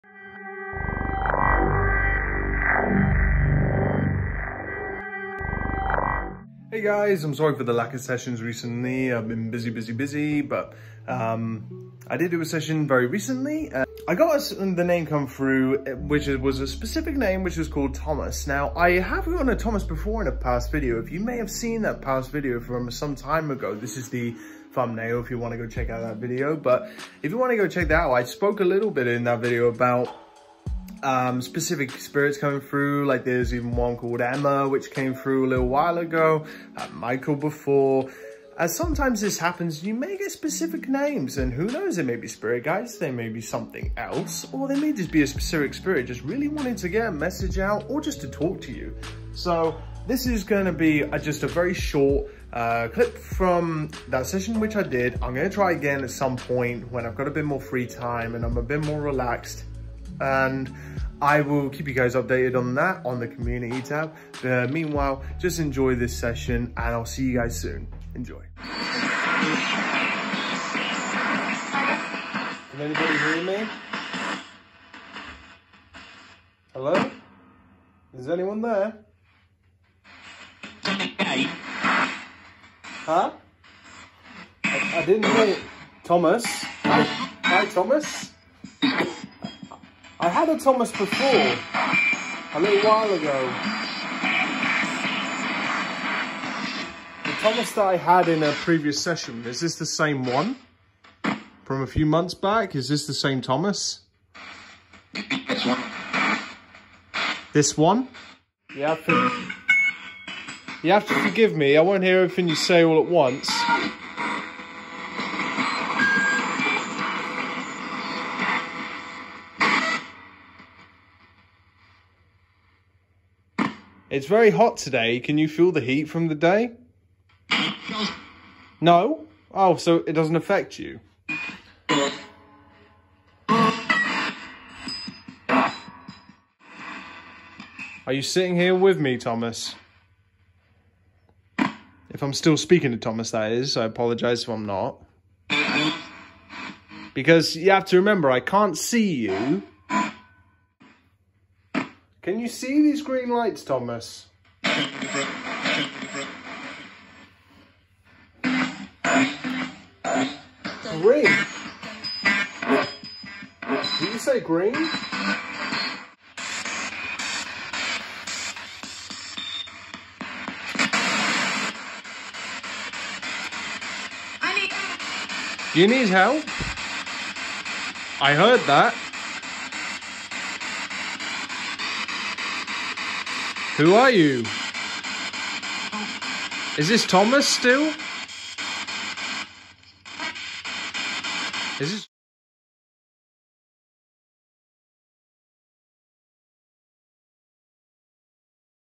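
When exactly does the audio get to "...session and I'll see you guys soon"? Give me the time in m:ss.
1:06.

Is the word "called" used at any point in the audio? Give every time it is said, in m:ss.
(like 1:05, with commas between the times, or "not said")
0:17, 0:33.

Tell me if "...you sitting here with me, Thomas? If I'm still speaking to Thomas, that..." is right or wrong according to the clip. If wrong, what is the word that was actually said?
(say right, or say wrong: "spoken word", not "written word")
right.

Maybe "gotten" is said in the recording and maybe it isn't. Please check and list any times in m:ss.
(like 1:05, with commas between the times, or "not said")
0:19.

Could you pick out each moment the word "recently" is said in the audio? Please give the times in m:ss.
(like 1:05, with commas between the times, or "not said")
0:08, 0:13.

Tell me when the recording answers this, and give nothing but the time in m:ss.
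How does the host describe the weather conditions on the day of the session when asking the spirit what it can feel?
2:04.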